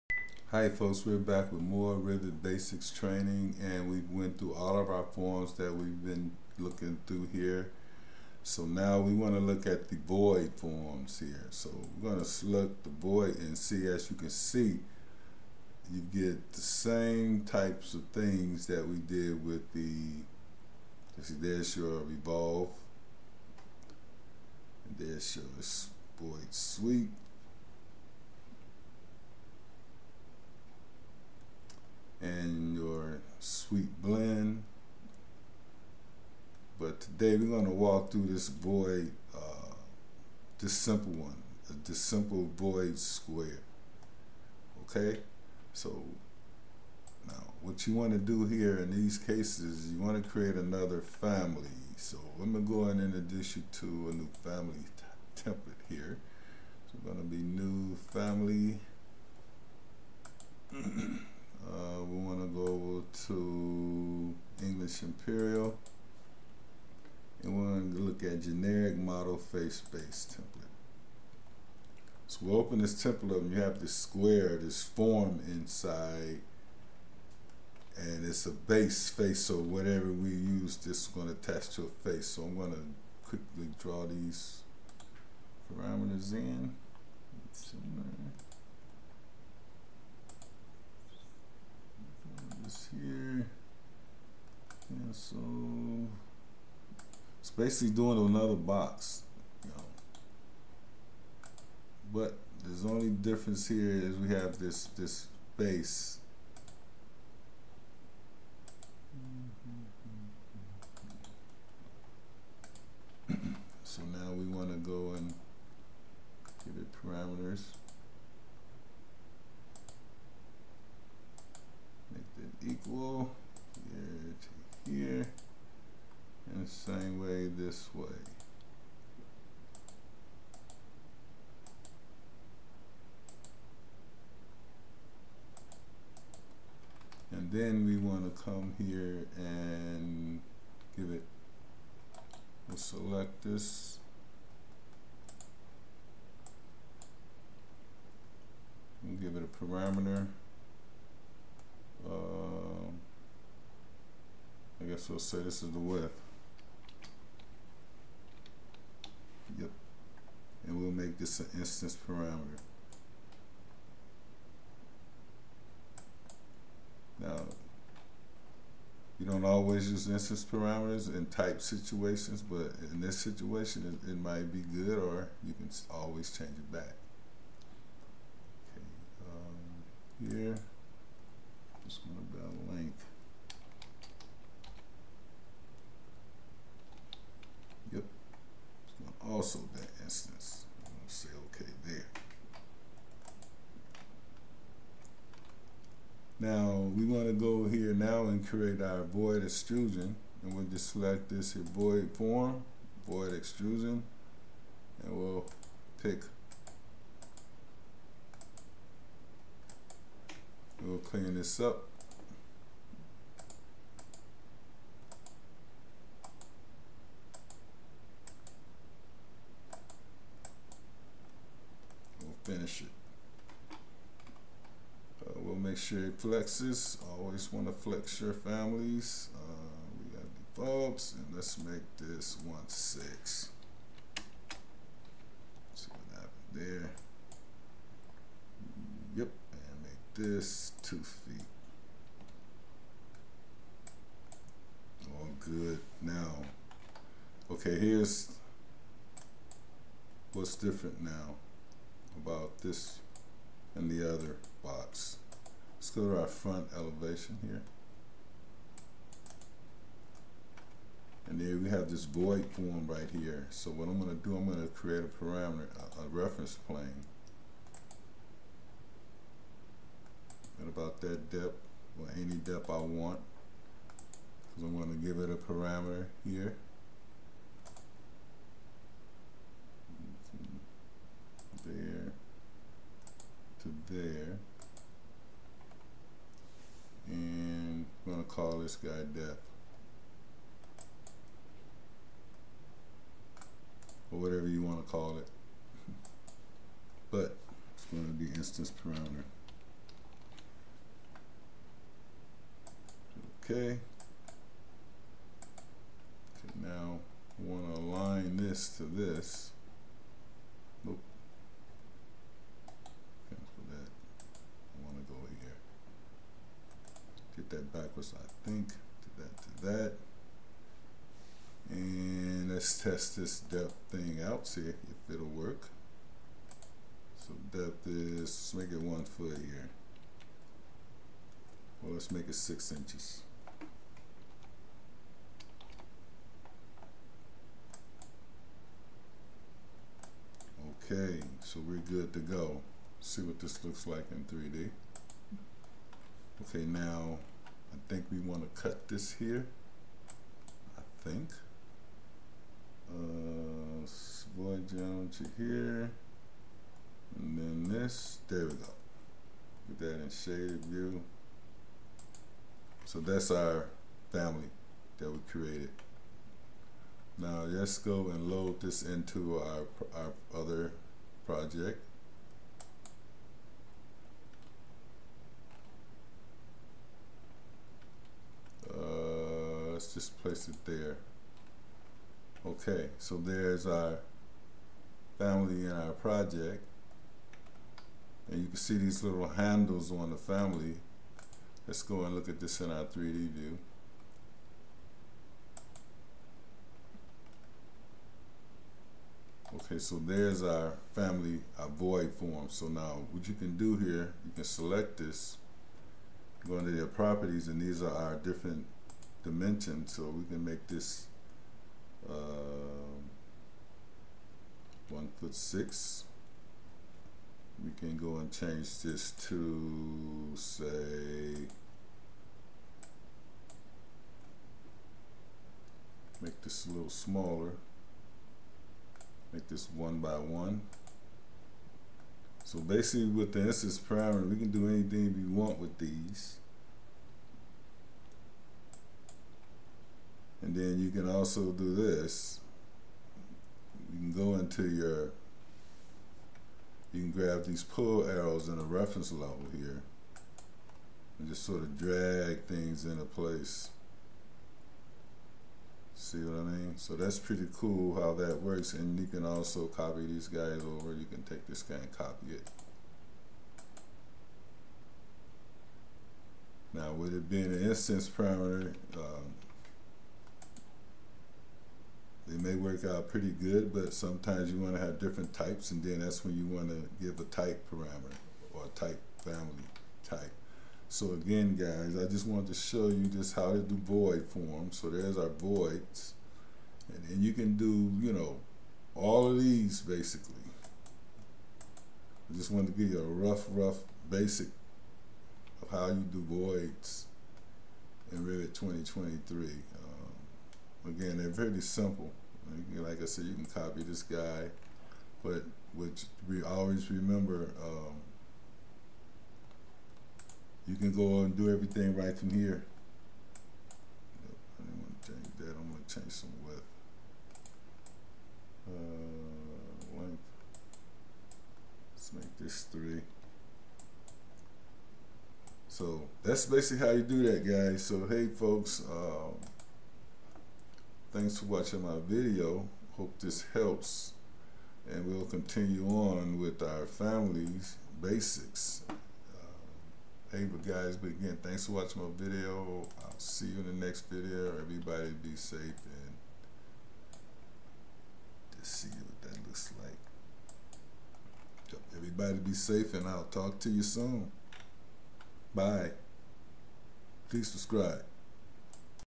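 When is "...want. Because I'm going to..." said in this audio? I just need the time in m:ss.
4:32.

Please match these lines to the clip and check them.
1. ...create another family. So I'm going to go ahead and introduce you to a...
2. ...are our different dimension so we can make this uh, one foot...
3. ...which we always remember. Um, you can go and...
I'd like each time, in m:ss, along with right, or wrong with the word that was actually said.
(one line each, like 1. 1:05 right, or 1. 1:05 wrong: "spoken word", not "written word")
1. 0:50 right
2. 6:47 right
3. 8:25 right.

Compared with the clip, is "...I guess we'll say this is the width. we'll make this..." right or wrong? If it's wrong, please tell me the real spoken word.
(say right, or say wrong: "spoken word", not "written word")
right.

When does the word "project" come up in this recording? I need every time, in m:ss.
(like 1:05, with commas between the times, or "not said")
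6:11, 6:25.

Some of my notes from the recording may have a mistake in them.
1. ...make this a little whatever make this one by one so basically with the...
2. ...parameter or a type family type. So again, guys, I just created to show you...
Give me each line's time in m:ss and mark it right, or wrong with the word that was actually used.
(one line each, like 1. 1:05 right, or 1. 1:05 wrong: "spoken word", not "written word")
1. 7:06 wrong: "smaller", not "whatever"
2. 7:57 wrong: "wanted", not "created".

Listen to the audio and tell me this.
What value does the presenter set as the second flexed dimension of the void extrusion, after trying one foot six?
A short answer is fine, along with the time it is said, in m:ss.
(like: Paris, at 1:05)
2 feet, at 4:00.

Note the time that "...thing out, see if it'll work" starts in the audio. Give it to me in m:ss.
5:23.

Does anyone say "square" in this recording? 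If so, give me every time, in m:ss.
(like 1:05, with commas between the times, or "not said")
0:42, 1:13.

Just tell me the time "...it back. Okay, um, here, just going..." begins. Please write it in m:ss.
2:56.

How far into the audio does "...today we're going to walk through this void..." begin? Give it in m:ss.
0:37.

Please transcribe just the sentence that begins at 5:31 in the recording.
Well, let's make it six inches.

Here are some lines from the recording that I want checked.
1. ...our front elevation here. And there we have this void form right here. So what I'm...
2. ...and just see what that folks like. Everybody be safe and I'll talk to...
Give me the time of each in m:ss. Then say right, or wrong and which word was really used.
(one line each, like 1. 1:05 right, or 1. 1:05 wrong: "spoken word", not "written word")
1. 4:16 right
2. 9:05 wrong: "looks", not "folks".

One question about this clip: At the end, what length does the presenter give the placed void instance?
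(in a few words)
3.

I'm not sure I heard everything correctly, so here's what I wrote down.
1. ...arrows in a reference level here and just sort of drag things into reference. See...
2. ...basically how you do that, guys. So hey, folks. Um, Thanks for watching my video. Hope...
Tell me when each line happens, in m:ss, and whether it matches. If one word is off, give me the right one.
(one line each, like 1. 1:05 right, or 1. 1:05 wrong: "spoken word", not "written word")
1. 7:28 wrong: "place", not "reference"
2. 8:46 right.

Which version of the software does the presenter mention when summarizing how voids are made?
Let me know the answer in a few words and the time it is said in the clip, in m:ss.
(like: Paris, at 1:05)
Revit 2023, at 8:18.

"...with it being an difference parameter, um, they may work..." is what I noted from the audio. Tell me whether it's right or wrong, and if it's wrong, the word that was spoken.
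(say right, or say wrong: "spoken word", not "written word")
wrong: "instance", not "difference".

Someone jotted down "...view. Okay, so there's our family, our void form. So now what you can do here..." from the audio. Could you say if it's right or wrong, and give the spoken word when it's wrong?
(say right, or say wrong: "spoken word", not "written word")
right.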